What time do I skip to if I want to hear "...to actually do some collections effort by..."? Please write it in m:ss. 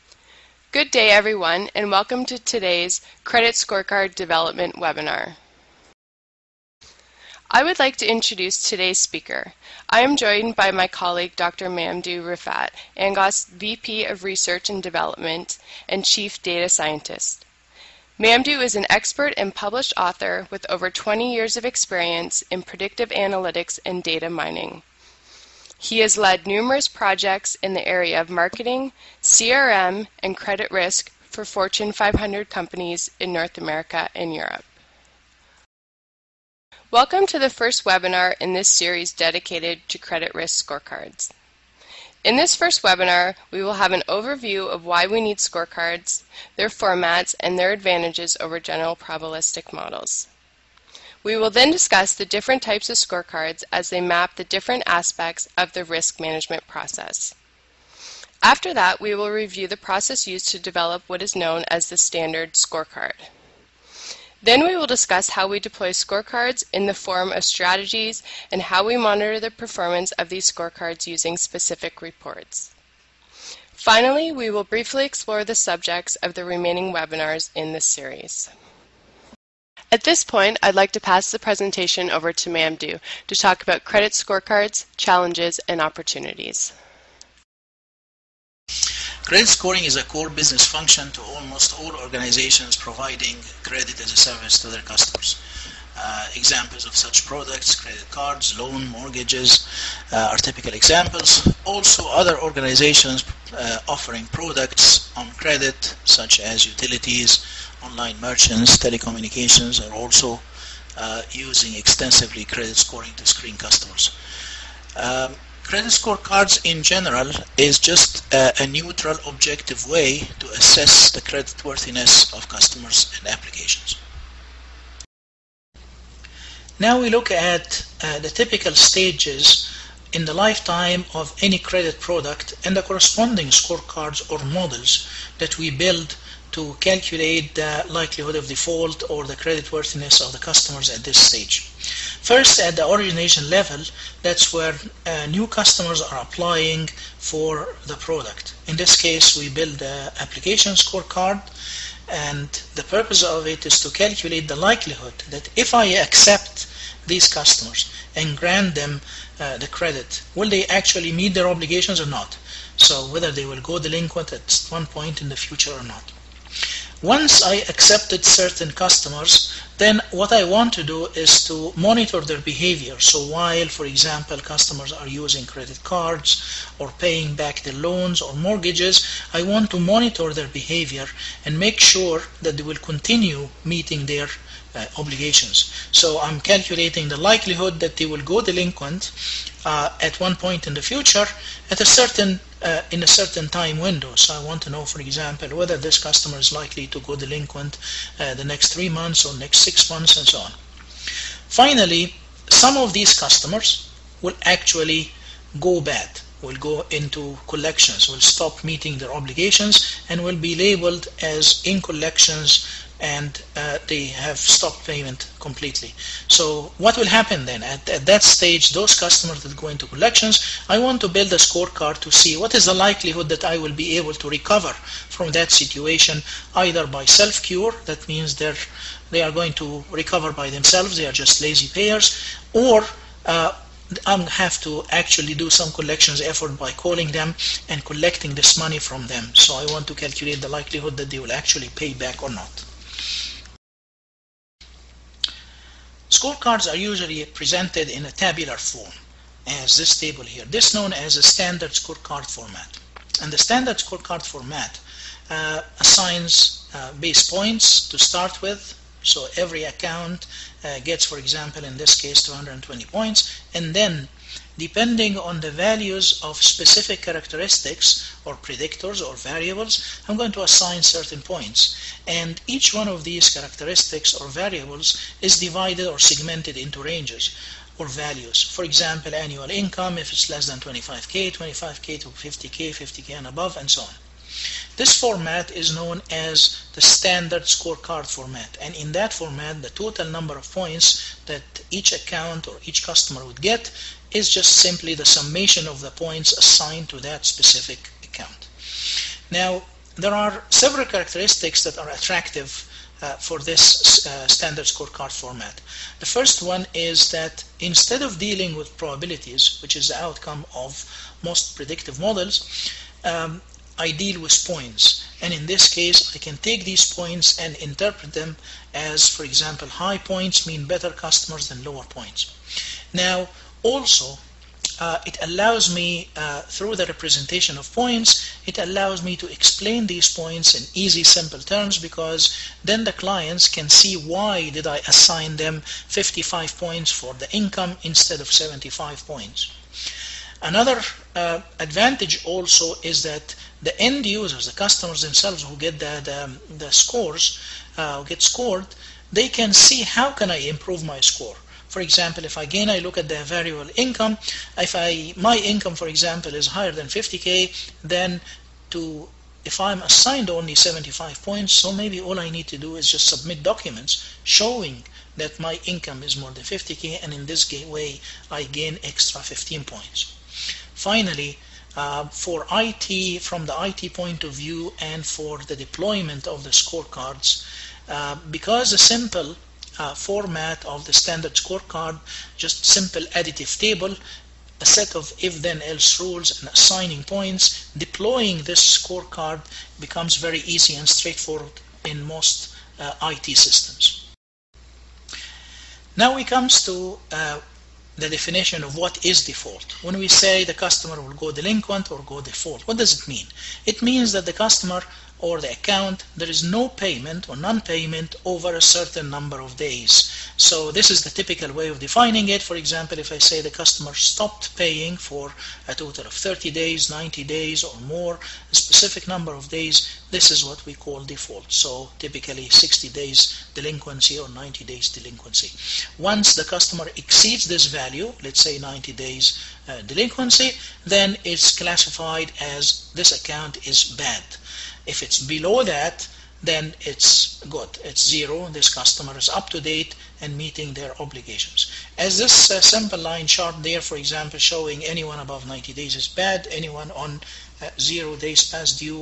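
3:54.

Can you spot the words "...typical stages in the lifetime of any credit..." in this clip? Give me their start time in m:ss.
2:08.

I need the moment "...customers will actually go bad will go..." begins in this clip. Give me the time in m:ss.
3:23.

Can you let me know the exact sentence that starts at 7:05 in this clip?
Once the customer exceeds this value, let's say 90 days uh, delinquency, then it's classified as this account is bad.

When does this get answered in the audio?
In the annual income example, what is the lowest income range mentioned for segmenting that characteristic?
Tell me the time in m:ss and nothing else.
4:40.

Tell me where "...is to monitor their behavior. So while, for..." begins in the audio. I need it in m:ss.
2:51.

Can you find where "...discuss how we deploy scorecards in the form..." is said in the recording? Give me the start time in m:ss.
1:04.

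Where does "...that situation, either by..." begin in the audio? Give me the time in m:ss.
3:45.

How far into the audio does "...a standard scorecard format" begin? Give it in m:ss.
4:11.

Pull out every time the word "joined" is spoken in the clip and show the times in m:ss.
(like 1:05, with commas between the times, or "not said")
0:10.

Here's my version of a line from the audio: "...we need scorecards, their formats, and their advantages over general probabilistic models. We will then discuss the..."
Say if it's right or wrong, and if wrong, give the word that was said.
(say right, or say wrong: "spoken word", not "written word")
right.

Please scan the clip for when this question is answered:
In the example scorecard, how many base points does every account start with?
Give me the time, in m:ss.
4:22.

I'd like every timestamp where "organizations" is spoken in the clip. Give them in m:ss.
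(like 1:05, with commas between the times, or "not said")
1:31, 1:42.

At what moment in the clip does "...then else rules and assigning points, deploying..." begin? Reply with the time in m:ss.
6:25.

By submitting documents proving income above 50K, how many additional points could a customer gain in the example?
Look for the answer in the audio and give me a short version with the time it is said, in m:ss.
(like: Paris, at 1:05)
15, at 6:08.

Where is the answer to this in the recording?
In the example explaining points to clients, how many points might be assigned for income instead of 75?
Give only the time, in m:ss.
5:35.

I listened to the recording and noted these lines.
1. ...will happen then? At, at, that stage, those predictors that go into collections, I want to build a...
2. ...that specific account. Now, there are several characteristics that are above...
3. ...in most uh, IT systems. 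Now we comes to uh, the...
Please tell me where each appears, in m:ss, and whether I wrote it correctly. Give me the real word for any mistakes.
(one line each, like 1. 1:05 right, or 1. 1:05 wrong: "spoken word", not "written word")
1. 3:36 wrong: "customers", not "predictors"
2. 4:56 wrong: "attractive", not "above"
3. 6:31 right.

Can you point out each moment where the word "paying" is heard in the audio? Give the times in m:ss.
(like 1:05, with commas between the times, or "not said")
2:56, 6:54.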